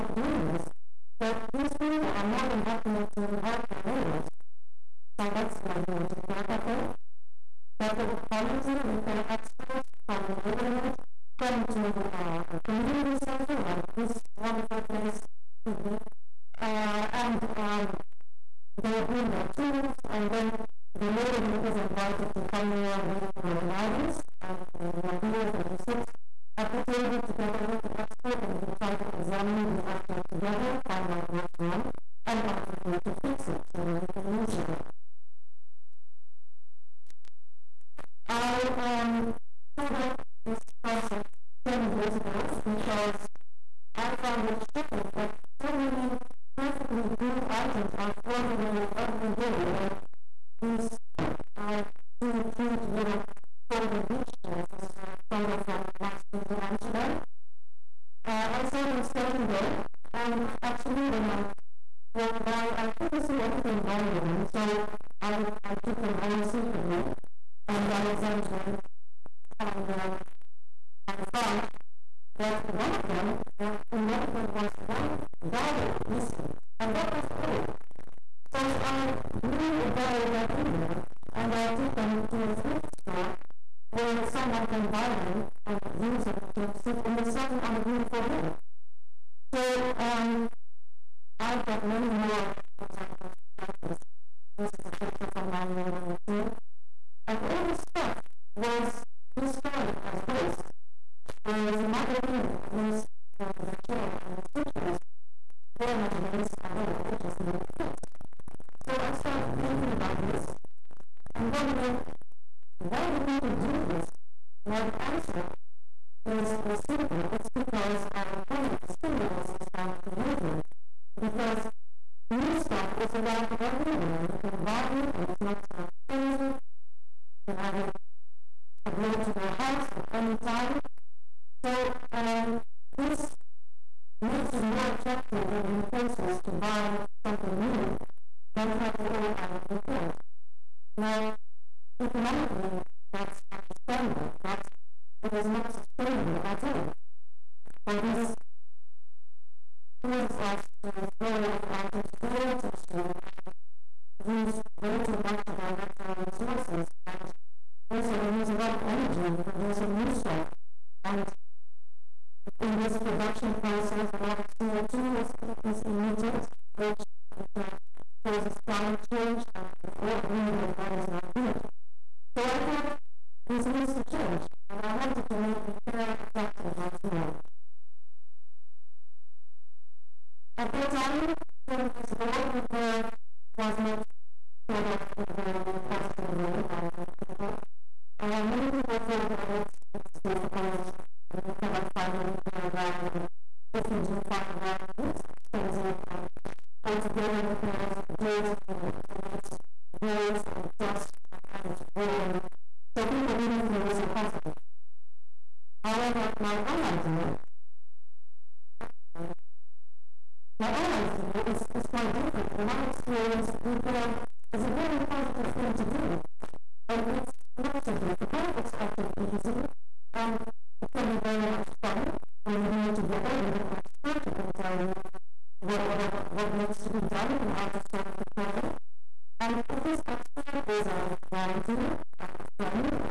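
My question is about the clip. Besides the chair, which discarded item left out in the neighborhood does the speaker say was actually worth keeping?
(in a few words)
The suitcase.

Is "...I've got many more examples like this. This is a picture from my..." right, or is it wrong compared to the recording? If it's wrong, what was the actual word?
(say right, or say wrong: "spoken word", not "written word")
right.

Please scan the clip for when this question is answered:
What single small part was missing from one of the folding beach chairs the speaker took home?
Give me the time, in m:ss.
1:14.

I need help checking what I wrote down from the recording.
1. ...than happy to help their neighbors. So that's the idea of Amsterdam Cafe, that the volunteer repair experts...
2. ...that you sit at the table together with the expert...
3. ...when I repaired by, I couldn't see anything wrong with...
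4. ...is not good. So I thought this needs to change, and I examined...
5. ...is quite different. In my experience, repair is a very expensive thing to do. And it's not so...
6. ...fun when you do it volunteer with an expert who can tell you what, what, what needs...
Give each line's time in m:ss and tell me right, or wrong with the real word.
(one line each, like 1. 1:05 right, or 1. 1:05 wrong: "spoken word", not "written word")
1. 0:02 wrong: "Repair", not "Amsterdam"
2. 0:25 right
3. 1:01 wrong: "walked", not "repaired"
4. 2:50 wrong: "wanted", not "examined"
5. 3:31 wrong: "positive", not "expensive"
6. 3:41 wrong: "together", not "volunteer".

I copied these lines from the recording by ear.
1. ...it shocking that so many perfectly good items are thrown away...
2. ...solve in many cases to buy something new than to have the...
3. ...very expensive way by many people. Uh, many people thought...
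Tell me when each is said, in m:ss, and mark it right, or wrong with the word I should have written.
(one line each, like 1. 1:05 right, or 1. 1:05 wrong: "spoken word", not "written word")
1. 0:44 right
2. 2:14 wrong: "attractive", not "solve"
3. 3:05 wrong: "positive", not "expensive".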